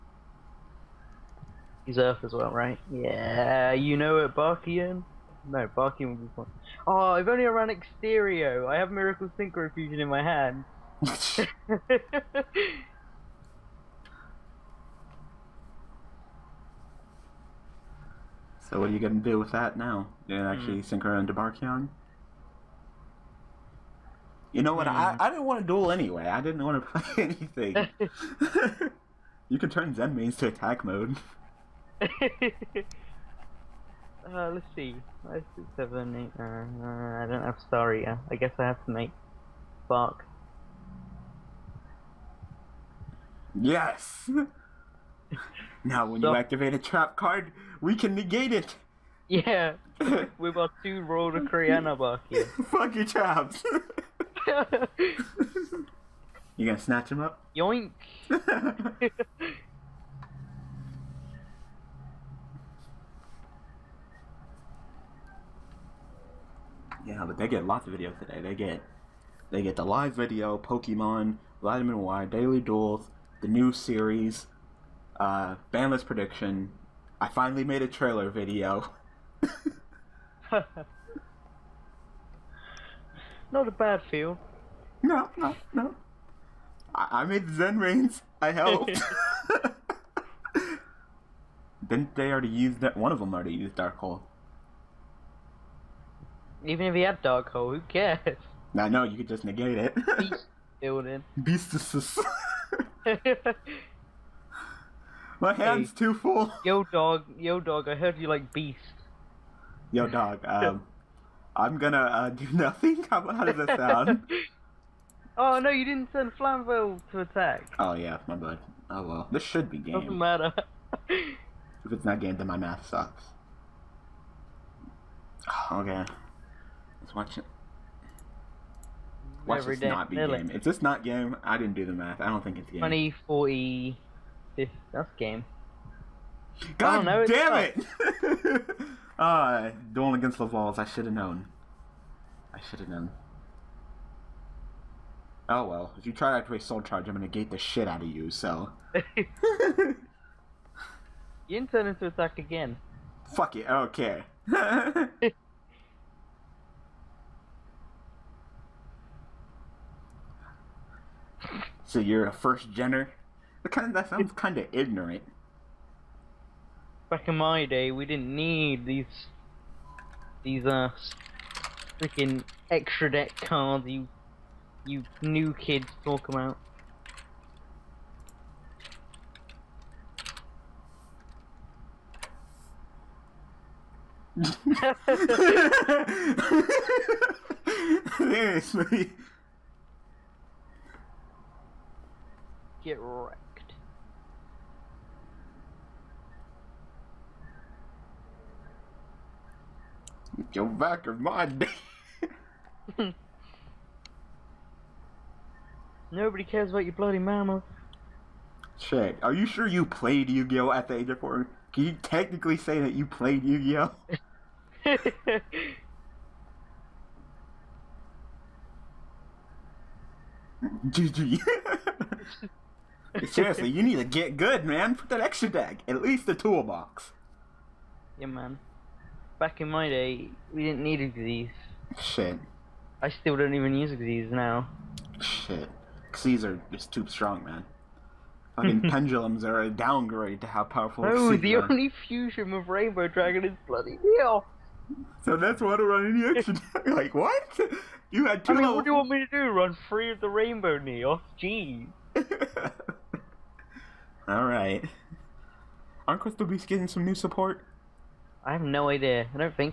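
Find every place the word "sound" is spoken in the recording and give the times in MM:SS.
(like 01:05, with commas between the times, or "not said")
01:53, 02:44.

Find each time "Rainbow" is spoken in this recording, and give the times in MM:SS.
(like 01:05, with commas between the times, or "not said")
04:02, 04:10.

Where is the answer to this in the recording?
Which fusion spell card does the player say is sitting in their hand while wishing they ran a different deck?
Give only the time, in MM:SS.
00:08.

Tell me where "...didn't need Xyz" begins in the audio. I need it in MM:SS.
03:50.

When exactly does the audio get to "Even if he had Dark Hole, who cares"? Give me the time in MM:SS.
01:36.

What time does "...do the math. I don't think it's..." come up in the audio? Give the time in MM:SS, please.
02:11.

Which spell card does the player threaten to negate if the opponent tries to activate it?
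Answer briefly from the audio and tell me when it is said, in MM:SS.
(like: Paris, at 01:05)
Soul Charge, at 02:26.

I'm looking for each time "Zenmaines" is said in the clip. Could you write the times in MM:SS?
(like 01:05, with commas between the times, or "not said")
00:29, 01:27.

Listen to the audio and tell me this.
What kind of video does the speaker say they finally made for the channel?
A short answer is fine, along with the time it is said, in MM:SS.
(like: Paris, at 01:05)
trailer video, at 01:17.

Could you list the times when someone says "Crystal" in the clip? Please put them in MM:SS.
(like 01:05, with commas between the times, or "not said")
04:16.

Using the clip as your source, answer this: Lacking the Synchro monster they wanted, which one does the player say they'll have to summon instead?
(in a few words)
Spark.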